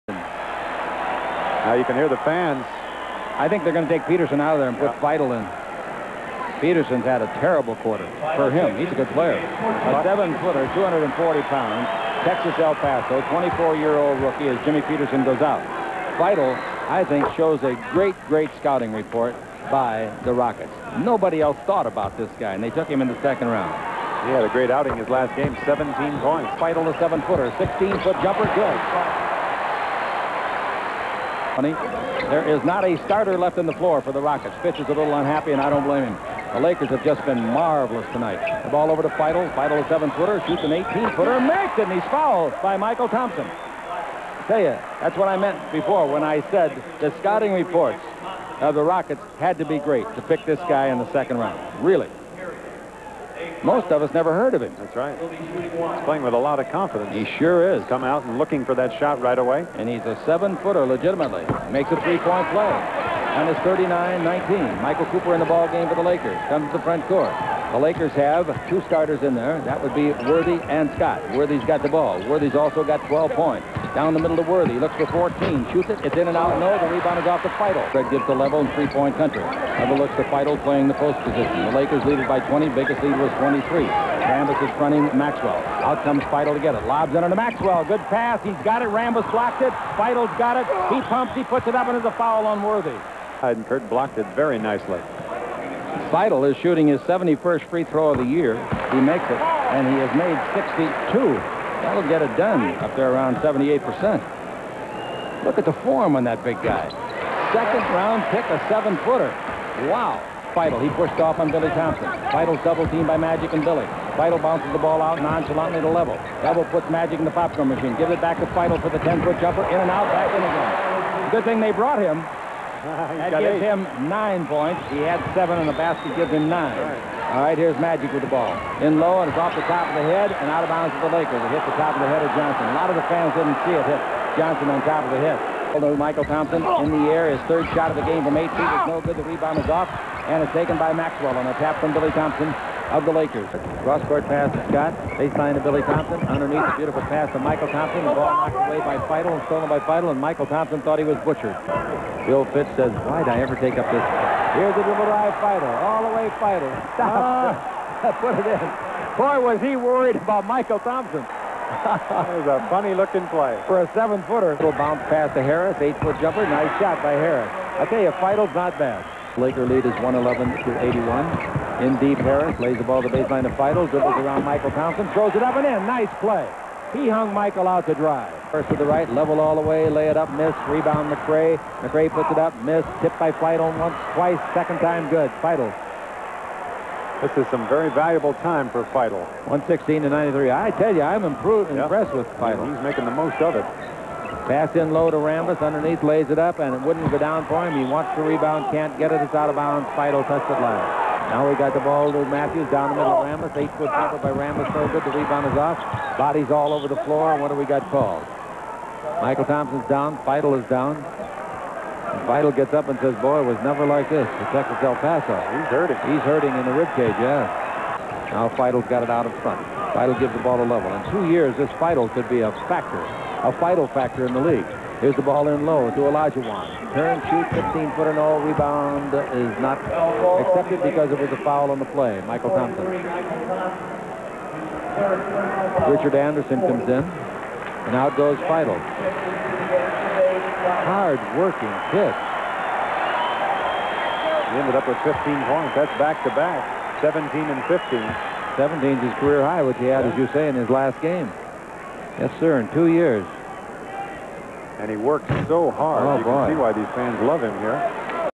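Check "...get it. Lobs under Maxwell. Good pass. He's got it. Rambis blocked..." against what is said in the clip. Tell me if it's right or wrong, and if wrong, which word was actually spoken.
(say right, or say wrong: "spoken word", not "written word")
right.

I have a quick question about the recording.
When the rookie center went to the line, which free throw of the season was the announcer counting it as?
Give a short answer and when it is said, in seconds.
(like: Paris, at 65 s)
71st, at 97 s.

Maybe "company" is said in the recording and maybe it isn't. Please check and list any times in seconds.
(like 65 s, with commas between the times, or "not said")
31 s.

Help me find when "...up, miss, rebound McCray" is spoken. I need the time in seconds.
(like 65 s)
180 s.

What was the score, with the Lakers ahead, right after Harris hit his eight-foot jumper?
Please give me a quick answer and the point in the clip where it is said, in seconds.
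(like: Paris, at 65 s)
111 to 81, at 170 s.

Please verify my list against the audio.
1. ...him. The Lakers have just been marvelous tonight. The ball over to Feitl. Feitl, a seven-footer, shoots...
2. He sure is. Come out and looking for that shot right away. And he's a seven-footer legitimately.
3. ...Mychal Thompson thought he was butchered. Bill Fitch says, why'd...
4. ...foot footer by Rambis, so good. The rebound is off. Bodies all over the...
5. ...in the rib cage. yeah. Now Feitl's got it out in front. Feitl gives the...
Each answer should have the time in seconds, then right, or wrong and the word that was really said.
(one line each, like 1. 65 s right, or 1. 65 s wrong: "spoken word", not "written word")
1. 36 s right
2. 57 s right
3. 150 s right
4. 203 s wrong: "jumper", not "footer"
5. 216 s right.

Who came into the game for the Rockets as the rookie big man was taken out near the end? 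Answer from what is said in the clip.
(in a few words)
Richard Anderson.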